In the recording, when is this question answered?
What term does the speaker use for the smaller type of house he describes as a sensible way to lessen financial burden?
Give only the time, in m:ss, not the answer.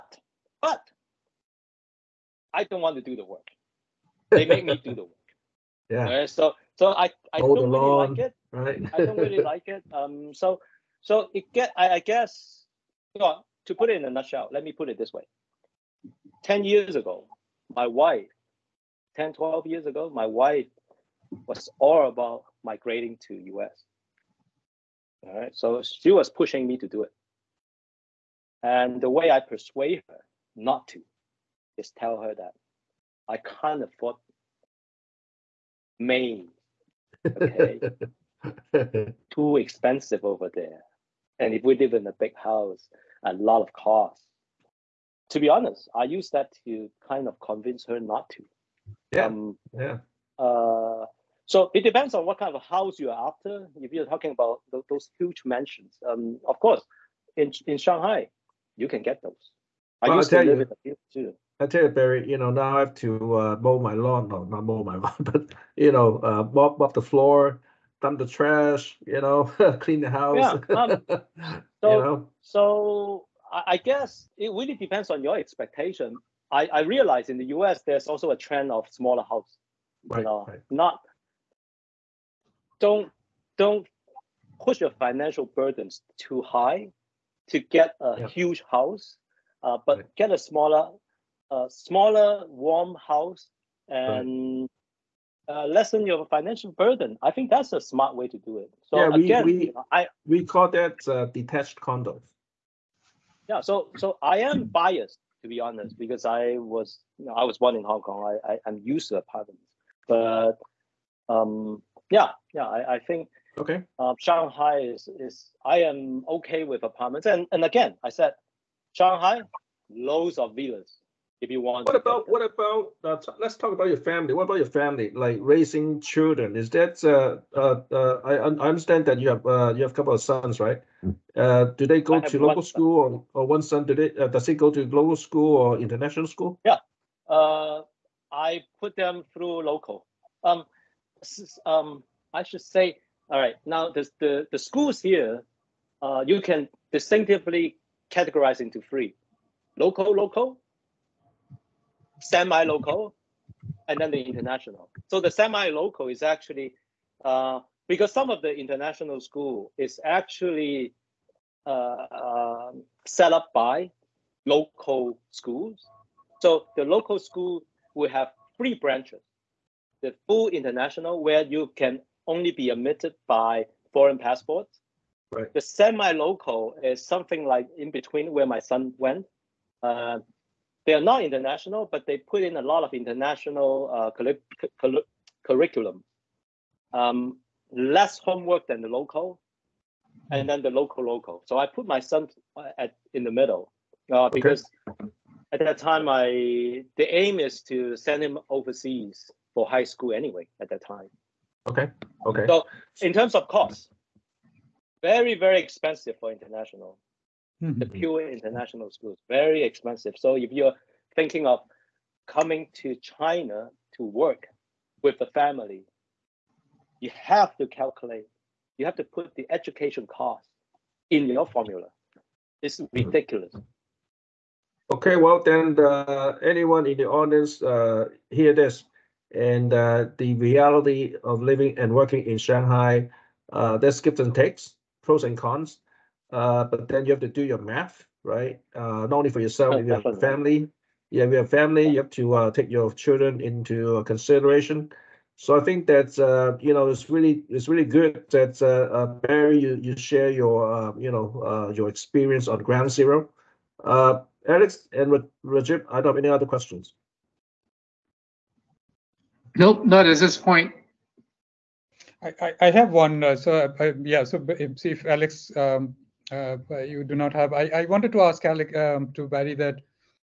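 1:41.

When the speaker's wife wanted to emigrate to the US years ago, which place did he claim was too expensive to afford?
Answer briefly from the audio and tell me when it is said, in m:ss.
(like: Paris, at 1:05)
Maine, at 0:35.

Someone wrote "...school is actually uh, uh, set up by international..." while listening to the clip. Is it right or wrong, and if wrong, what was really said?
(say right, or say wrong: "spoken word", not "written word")
wrong: "local", not "international".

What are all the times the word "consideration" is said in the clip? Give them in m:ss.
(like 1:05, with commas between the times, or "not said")
4:04.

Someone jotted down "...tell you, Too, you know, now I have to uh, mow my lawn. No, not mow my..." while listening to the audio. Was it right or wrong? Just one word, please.
wrong.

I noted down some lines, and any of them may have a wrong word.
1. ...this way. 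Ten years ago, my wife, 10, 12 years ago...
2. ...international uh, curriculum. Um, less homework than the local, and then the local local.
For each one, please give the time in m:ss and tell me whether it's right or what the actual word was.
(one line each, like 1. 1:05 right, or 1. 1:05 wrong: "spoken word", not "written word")
1. 0:14 right
2. 3:02 right.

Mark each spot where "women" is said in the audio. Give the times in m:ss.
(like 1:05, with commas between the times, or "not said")
not said.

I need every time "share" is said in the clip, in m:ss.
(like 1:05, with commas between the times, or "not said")
4:09.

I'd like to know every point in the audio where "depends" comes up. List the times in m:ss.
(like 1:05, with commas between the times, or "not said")
0:51, 1:14.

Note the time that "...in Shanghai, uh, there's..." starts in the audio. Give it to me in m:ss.
3:52.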